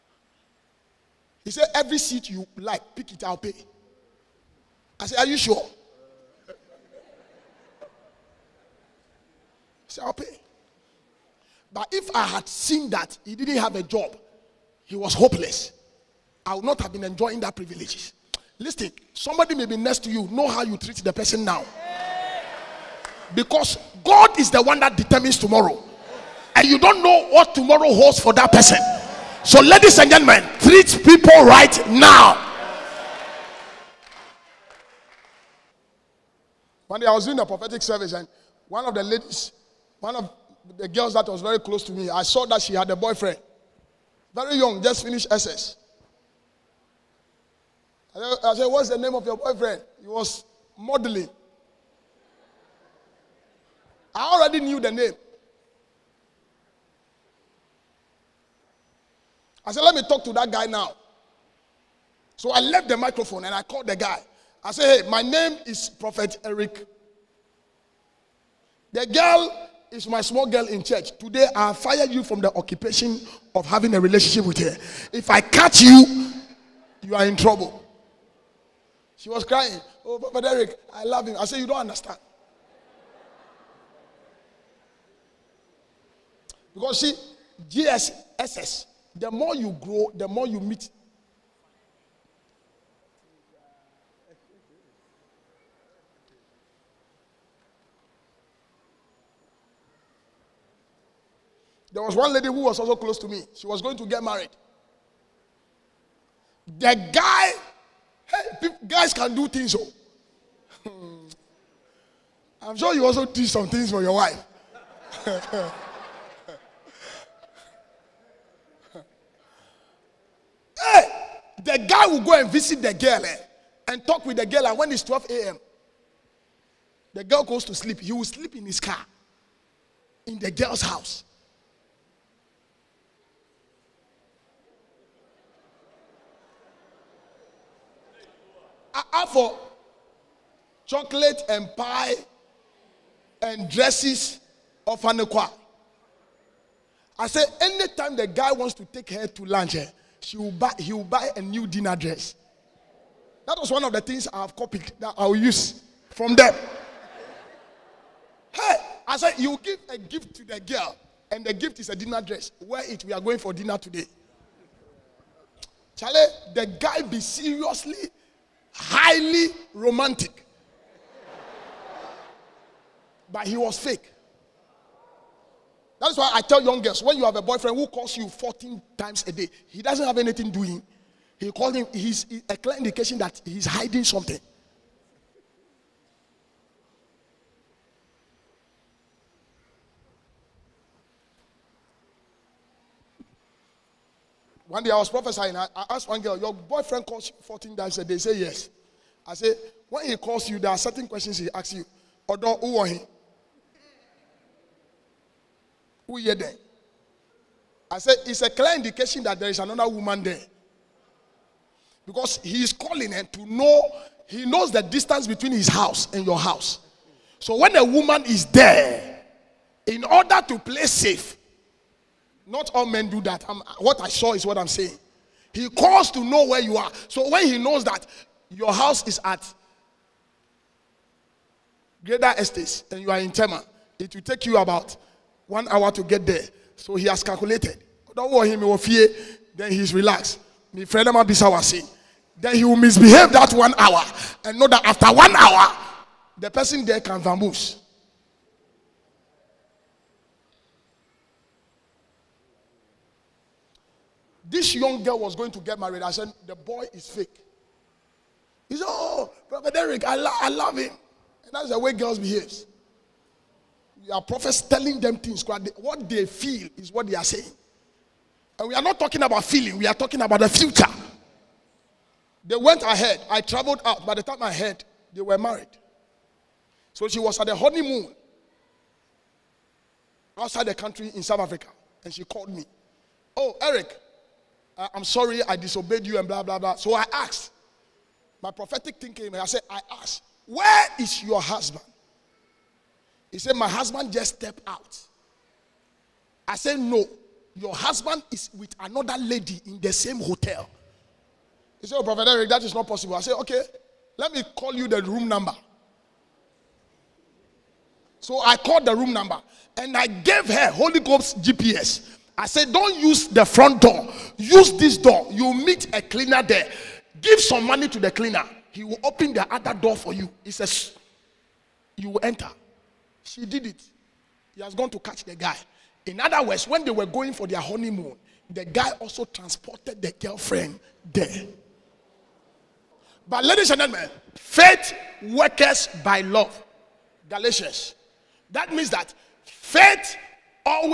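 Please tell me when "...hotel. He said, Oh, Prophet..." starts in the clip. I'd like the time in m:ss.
5:00.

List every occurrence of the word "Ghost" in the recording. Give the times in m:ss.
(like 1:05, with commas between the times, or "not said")
5:11.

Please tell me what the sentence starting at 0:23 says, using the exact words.
Because God is the one that determines tomorrow.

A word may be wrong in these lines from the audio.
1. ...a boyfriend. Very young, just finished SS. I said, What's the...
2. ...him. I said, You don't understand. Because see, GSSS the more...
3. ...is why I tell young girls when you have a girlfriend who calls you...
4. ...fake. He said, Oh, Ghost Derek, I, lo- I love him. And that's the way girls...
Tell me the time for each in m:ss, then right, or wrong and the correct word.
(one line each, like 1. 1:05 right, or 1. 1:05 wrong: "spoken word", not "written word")
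1. 0:42 right
2. 1:21 right
3. 2:56 wrong: "boyfriend", not "girlfriend"
4. 4:17 wrong: "Brother", not "Ghost".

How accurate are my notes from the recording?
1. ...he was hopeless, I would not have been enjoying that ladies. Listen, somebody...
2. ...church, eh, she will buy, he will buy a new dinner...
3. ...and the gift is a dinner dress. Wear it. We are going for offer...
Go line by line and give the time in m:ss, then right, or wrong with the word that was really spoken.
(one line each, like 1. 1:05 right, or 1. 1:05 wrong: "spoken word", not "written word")
1. 0:14 wrong: "privileges", not "ladies"
2. 2:29 wrong: "lunch", not "church"
3. 2:41 wrong: "dinner", not "offer".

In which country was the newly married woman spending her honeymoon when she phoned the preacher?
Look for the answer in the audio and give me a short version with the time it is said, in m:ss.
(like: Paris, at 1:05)
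South Africa, at 4:41.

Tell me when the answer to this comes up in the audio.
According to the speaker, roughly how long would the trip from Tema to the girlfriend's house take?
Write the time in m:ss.
3:54.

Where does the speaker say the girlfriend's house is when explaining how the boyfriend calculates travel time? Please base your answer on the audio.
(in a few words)
Greda Estates.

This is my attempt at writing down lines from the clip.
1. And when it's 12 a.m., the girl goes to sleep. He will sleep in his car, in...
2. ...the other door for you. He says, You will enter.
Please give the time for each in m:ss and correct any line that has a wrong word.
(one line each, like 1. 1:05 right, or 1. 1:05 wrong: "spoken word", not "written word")
1. 2:04 right
2. 5:19 right.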